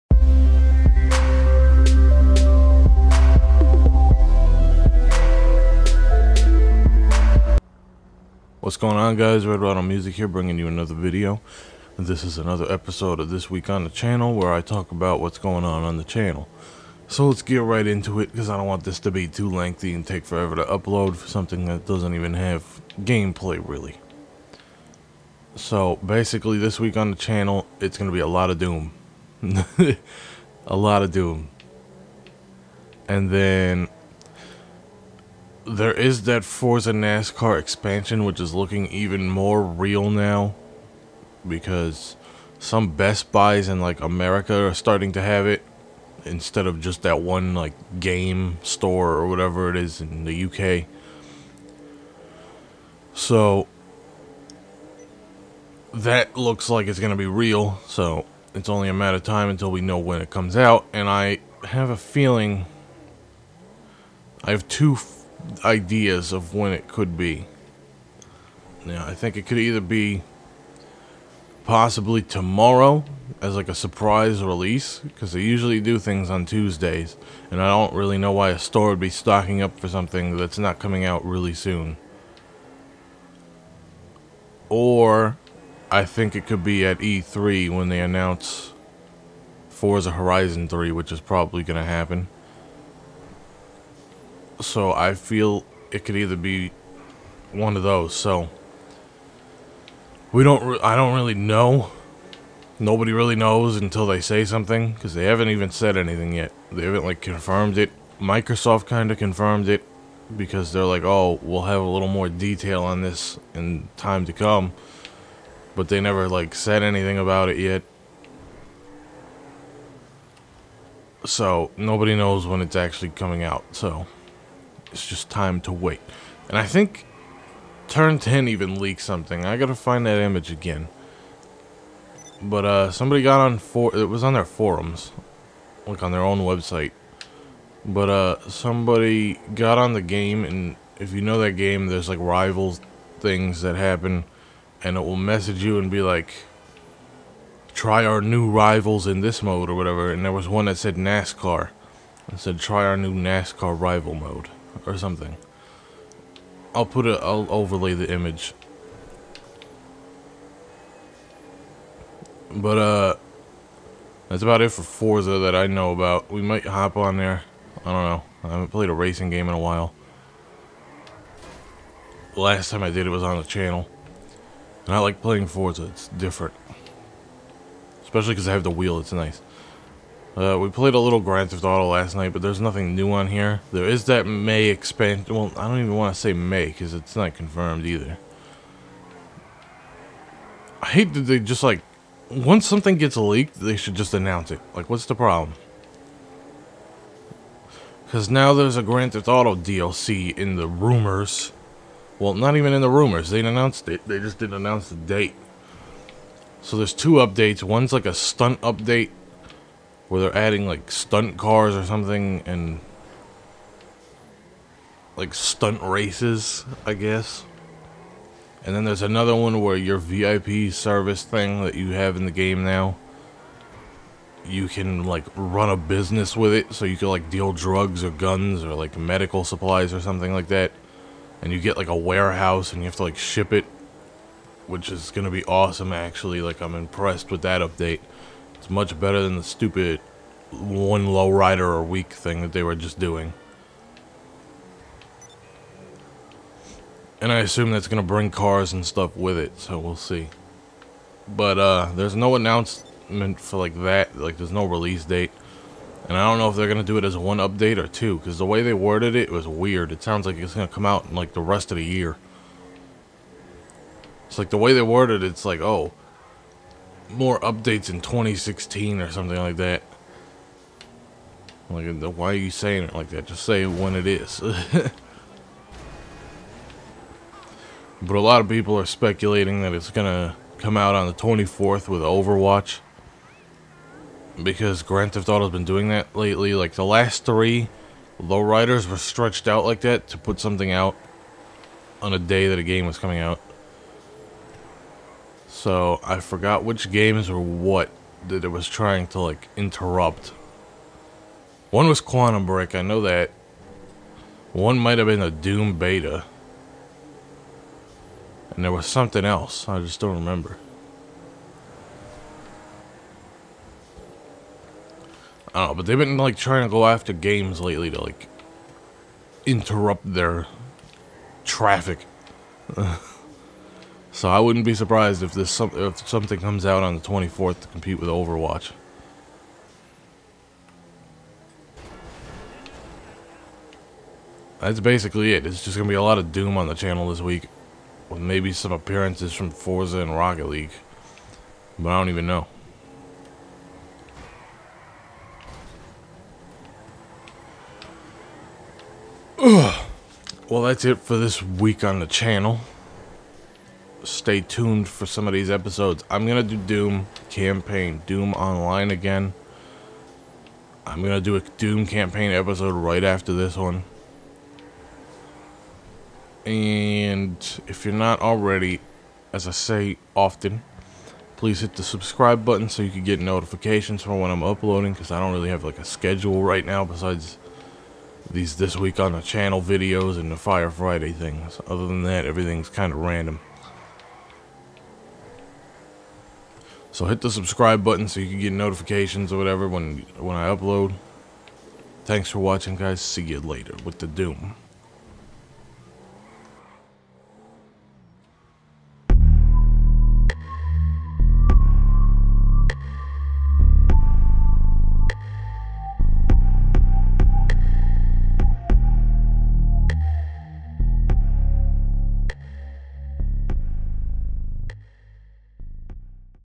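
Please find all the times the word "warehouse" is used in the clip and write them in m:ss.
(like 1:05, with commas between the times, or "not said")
3:51.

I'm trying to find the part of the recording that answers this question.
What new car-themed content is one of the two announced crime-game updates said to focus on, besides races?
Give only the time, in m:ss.
3:30.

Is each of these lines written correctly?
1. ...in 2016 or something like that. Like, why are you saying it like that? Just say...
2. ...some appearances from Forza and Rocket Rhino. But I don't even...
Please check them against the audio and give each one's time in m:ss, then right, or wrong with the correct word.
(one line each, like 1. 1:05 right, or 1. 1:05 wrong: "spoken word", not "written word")
1. 4:27 right
2. 5:38 wrong: "League", not "Rhino".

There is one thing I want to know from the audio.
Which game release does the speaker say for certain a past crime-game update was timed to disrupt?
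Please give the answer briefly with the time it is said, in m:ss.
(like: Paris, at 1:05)
Quantum Break, at 5:02.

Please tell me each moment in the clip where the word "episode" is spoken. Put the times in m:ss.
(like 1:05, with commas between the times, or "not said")
0:12, 5:55, 6:02.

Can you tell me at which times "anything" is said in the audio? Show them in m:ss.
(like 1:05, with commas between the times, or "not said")
1:45, 1:56.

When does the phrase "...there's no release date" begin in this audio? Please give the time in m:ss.
4:14.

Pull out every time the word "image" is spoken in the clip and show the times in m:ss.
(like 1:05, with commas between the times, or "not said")
2:10, 2:38.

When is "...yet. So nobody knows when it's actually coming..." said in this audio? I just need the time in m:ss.
1:57.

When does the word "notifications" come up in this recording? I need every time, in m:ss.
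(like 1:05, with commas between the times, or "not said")
6:13, 6:28.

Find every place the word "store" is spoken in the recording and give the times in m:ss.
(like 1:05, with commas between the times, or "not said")
0:48, 1:18.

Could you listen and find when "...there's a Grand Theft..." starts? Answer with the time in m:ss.
3:18.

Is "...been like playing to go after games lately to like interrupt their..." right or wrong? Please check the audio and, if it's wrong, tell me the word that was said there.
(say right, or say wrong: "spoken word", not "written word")
wrong: "trying", not "playing".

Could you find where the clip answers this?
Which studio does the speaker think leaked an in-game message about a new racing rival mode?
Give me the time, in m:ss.
2:07.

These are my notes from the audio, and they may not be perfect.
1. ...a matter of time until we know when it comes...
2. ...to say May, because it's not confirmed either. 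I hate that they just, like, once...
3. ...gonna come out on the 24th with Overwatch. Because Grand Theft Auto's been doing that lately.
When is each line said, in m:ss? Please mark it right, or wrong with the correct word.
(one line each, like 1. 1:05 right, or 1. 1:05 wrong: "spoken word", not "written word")
1. 0:58 right
2. 3:06 right
3. 4:39 right.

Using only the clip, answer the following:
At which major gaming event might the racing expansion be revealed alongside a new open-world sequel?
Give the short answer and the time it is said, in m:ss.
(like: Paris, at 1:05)
E3, at 1:26.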